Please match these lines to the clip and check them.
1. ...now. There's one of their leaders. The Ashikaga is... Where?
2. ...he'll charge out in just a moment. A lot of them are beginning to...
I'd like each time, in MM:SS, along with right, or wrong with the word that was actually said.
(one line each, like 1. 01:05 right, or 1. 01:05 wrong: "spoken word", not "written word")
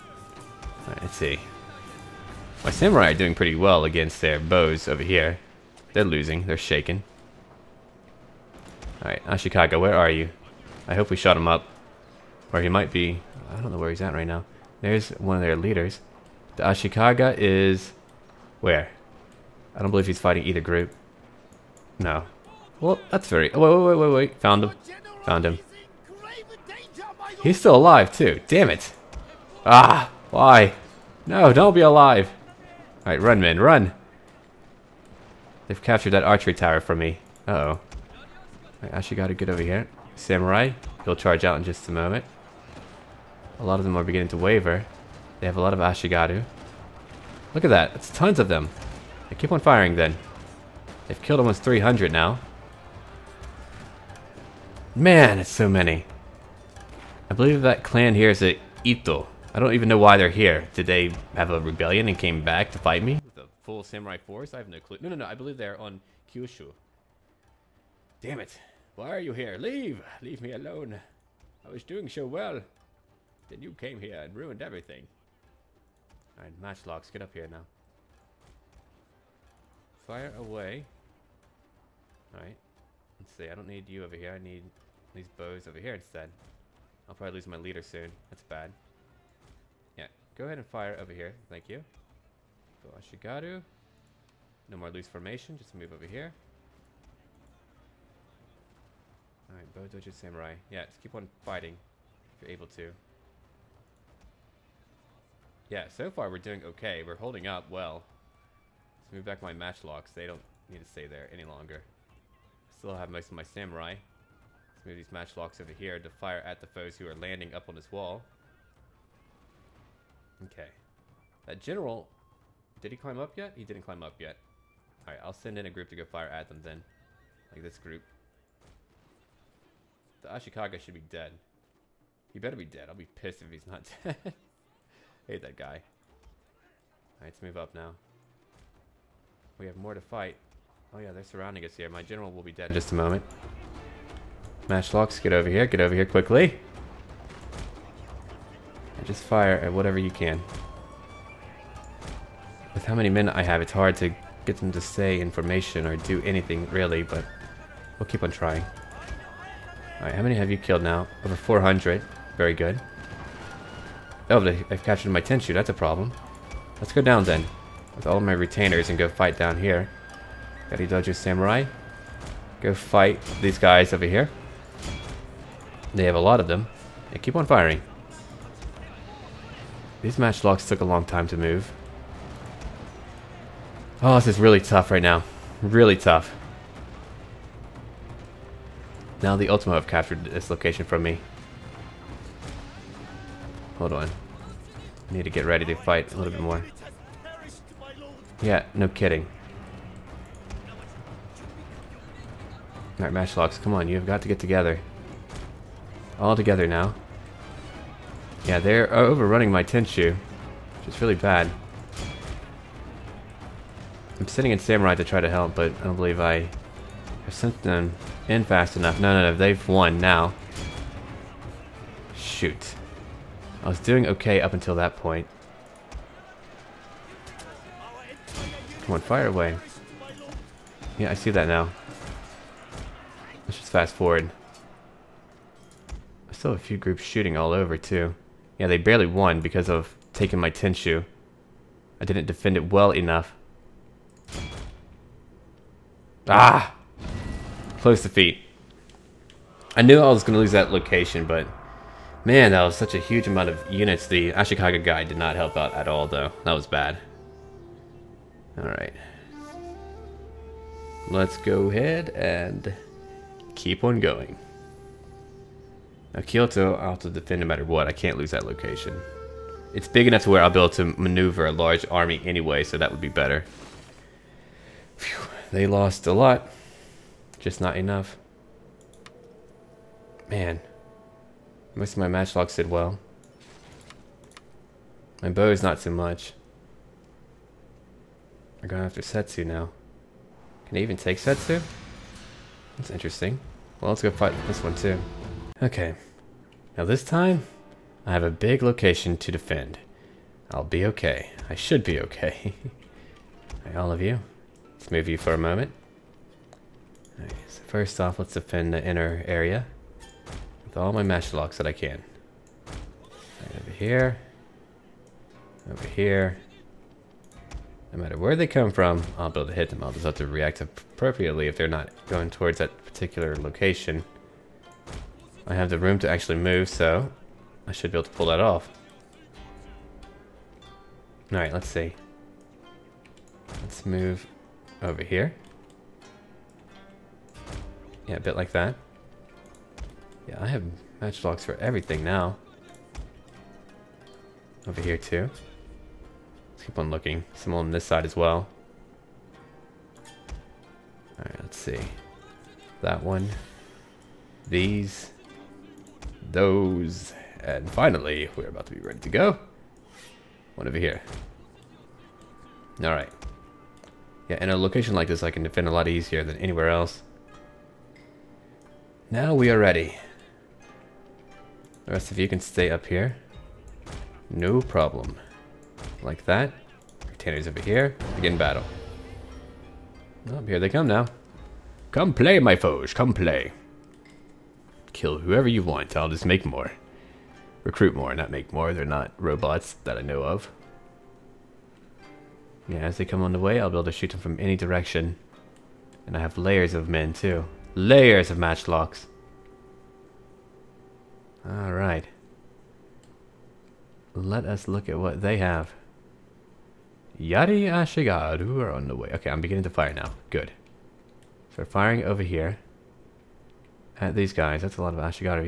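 1. 00:14 right
2. 00:41 right.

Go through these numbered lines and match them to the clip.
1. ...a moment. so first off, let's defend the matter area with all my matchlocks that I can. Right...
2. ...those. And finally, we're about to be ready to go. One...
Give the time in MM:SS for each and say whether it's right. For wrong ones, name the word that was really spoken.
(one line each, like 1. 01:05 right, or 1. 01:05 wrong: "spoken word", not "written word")
1. 05:05 wrong: "inner", not "matter"
2. 05:56 right.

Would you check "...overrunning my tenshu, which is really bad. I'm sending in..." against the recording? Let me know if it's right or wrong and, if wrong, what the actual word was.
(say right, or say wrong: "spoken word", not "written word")
right.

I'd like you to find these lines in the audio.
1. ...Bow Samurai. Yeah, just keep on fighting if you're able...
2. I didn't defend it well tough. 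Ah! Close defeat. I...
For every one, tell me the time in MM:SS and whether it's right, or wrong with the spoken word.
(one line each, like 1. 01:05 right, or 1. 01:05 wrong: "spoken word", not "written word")
1. 01:39 right
2. 04:02 wrong: "enough", not "tough".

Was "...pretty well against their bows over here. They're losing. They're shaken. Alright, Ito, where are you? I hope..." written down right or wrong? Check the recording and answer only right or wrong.
wrong.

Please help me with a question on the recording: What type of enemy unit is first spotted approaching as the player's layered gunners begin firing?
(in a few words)
Yari Ashigaru.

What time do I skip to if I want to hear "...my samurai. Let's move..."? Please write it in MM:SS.
01:53.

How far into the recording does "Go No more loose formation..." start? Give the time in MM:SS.
01:32.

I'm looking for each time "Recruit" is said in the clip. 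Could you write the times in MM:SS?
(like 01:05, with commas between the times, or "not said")
06:27.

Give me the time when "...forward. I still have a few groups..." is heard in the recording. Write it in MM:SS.
03:53.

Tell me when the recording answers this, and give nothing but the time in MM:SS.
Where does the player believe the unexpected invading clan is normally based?
01:06.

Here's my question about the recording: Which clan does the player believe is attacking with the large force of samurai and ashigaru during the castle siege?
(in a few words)
Ito.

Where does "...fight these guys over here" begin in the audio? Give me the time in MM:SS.
02:52.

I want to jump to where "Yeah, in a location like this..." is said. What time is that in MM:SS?
06:04.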